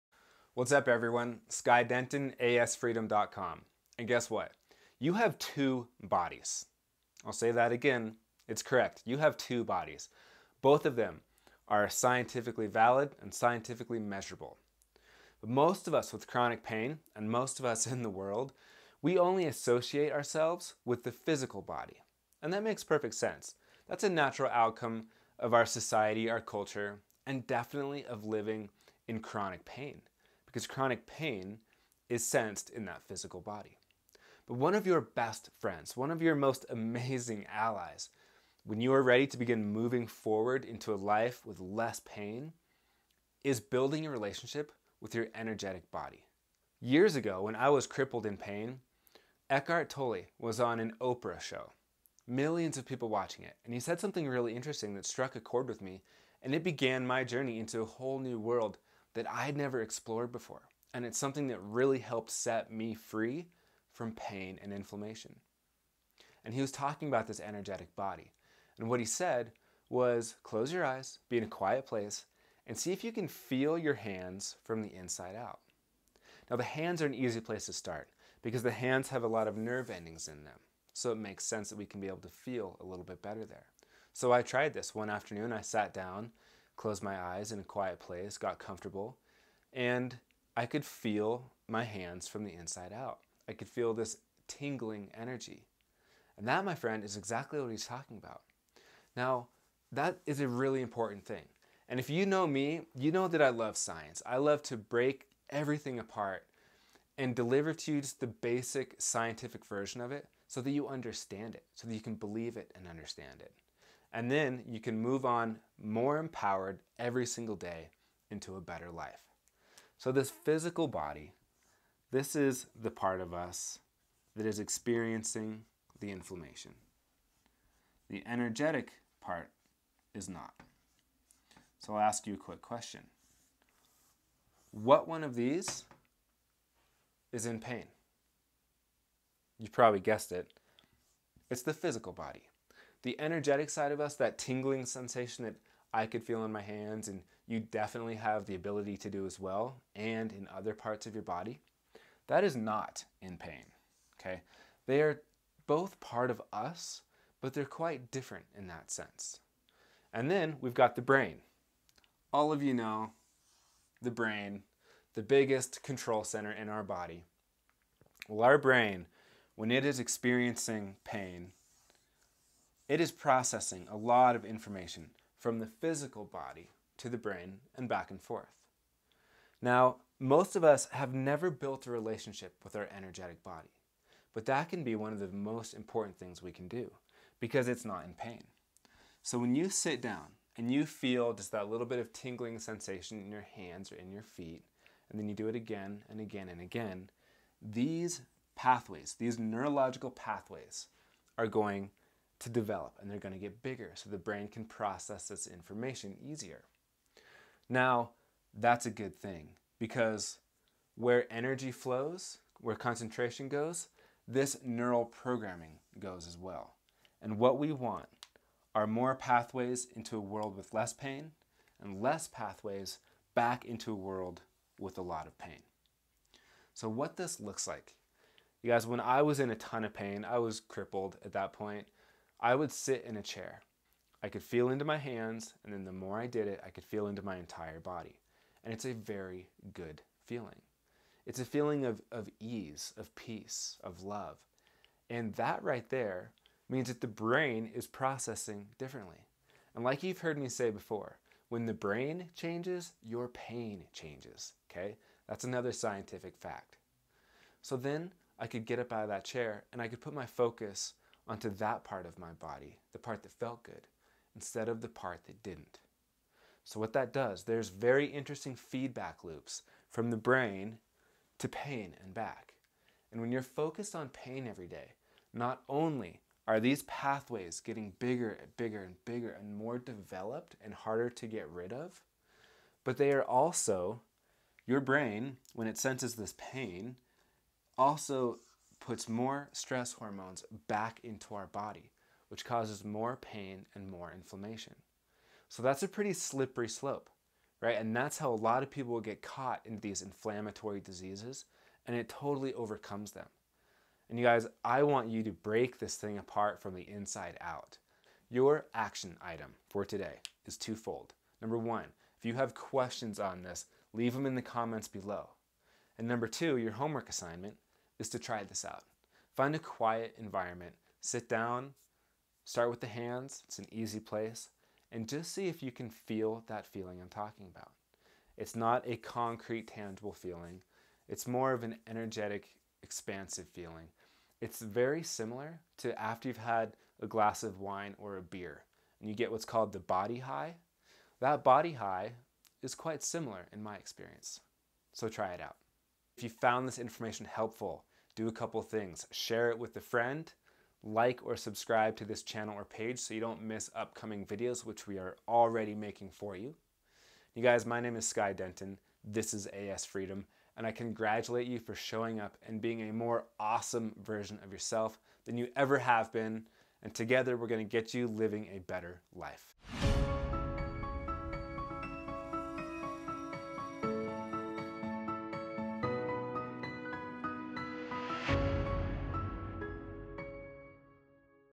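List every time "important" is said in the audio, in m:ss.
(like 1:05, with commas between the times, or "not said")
1:40, 3:05.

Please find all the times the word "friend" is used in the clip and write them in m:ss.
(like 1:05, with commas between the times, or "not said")
0:35, 1:36, 5:49.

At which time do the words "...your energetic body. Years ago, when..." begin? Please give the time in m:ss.
0:45.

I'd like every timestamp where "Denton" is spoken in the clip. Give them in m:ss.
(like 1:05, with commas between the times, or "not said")
0:01, 5:58.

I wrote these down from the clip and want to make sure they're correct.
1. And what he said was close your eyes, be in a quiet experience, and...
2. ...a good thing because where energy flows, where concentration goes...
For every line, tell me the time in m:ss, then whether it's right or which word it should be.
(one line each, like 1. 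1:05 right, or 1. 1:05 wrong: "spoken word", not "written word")
1. 1:08 wrong: "place", not "experience"
2. 3:28 right.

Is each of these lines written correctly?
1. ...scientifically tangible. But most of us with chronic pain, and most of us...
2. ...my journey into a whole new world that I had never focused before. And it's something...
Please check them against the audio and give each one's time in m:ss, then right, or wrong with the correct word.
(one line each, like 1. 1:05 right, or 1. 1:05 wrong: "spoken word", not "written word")
1. 0:13 wrong: "measurable", not "tangible"
2. 0:57 wrong: "explored", not "focused".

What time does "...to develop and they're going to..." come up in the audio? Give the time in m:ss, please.
3:22.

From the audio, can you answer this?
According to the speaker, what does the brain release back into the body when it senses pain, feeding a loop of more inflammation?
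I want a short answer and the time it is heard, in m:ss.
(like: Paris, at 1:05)
stress hormones, at 4:49.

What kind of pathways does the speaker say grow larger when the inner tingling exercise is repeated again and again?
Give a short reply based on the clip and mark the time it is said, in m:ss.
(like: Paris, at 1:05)
neurological pathways, at 3:19.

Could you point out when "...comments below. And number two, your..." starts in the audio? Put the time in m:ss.
5:14.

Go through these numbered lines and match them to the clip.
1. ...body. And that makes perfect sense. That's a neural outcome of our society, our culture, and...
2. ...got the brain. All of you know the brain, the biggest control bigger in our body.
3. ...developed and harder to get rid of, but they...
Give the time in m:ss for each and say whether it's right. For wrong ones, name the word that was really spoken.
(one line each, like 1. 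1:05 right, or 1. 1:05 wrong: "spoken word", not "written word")
1. 0:21 wrong: "natural", not "neural"
2. 2:40 wrong: "center", not "bigger"
3. 4:39 right.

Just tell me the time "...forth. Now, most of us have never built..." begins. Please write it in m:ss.
2:58.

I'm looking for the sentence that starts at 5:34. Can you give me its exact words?
It's very similar to after you've had a glass of wine or a beer, and you get what's called the body high.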